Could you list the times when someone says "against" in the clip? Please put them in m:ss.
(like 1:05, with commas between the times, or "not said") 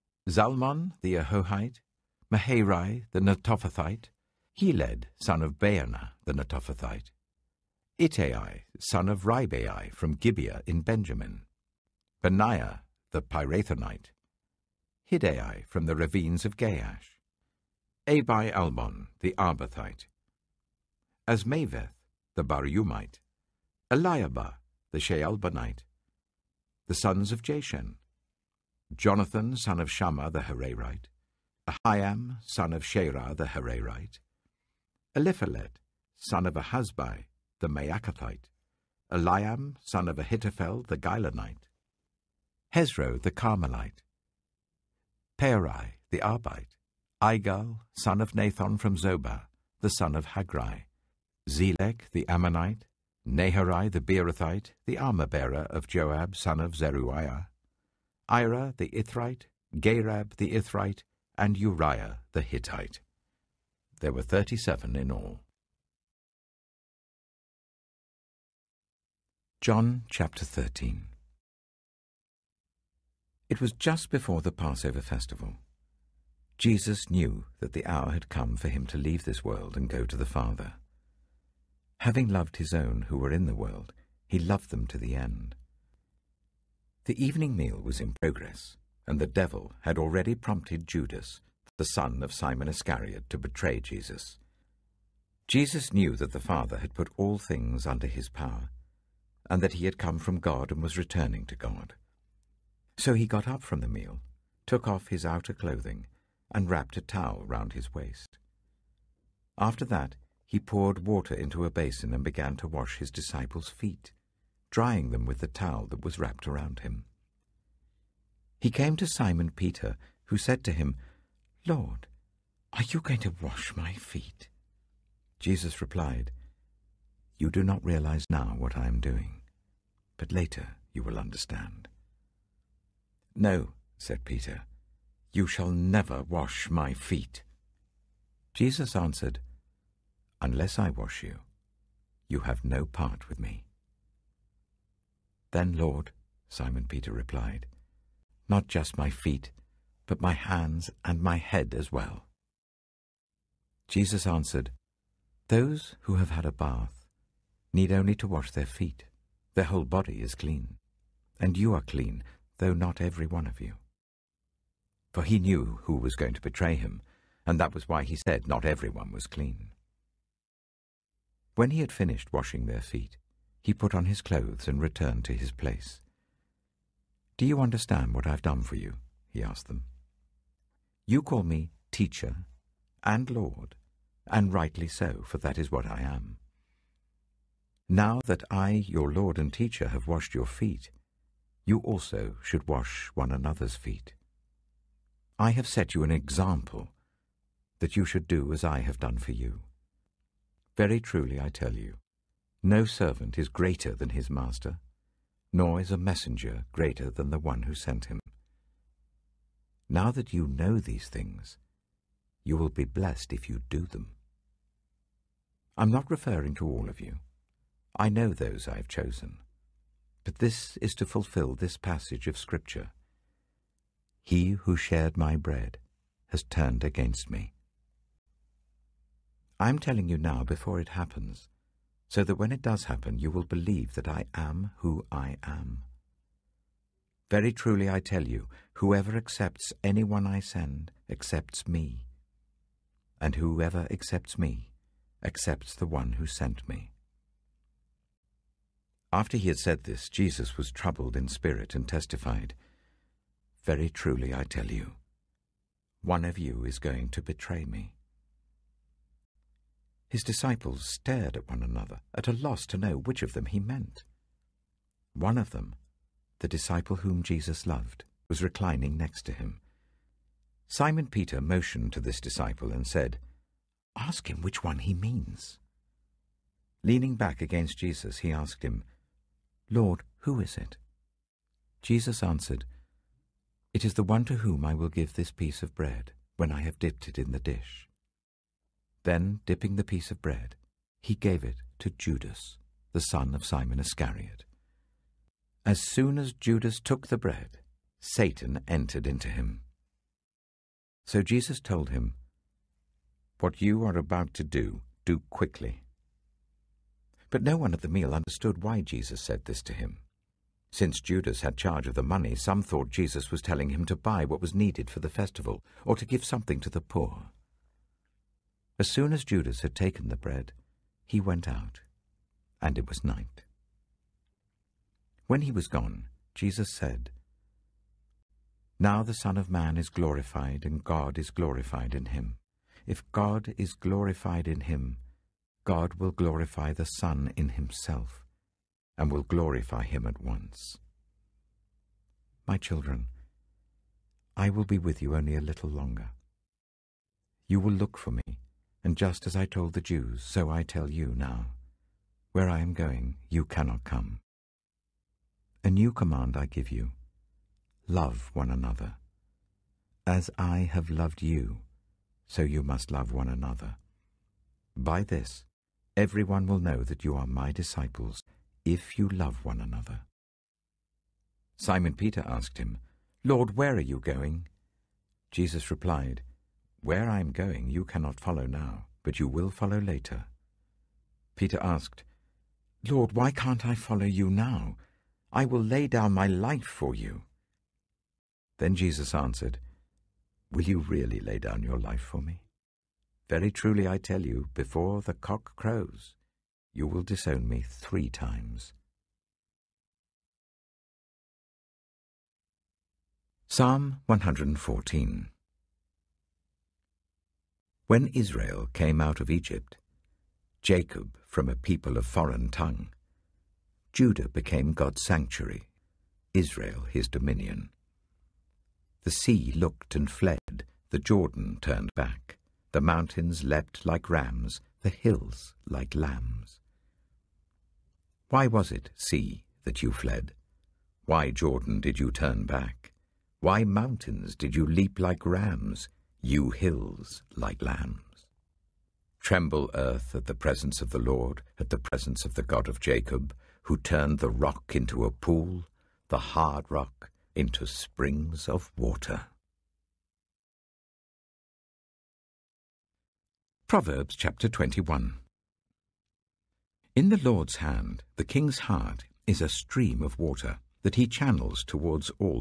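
3:46, 4:37.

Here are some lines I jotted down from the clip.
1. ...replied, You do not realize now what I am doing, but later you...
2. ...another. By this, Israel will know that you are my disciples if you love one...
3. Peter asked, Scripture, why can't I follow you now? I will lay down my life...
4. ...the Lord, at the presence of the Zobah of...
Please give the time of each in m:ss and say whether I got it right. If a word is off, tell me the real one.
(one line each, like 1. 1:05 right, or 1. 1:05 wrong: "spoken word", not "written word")
1. 2:05 right
2. 6:03 wrong: "Everyone", not "Israel"
3. 6:21 wrong: "Lord", not "Scripture"
4. 7:20 wrong: "God", not "Zobah".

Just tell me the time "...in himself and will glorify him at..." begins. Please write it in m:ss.
5:37.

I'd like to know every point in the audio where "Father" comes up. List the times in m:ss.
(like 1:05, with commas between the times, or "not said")
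1:20, 1:36.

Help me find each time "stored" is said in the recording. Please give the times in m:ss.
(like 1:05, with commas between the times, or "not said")
not said.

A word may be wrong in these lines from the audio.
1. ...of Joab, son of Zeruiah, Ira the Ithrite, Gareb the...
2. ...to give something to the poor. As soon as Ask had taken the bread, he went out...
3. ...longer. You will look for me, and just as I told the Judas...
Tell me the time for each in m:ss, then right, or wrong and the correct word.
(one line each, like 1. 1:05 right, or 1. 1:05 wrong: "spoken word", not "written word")
1. 0:55 right
2. 5:15 wrong: "Judas", not "Ask"
3. 5:45 wrong: "Jews", not "Judas".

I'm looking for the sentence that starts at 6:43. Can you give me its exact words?
Psalm 114 When Israel came out of Egypt, Jacob from a people of foreign tongue, Judah became God's sanctuary, Israel his dominion.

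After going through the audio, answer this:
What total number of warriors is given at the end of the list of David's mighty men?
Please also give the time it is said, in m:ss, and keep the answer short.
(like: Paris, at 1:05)
37, at 1:04.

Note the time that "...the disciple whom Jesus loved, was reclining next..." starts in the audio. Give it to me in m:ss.
4:26.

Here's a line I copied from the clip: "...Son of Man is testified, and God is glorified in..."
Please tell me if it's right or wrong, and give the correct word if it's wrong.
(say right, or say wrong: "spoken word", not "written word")
wrong: "glorified", not "testified".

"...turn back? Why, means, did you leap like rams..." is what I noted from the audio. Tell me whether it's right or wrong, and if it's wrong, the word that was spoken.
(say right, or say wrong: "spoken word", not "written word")
wrong: "mountains", not "means".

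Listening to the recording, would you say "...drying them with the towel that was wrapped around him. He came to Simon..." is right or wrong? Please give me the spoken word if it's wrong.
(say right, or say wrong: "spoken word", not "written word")
right.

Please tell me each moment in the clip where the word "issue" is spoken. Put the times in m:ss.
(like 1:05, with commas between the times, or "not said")
not said.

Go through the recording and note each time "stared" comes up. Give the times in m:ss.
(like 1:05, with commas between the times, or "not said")
4:20.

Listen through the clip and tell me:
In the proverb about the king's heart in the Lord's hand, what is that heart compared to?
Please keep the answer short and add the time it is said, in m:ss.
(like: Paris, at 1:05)
A stream of water, at 7:39.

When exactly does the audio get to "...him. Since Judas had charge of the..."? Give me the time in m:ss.
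5:09.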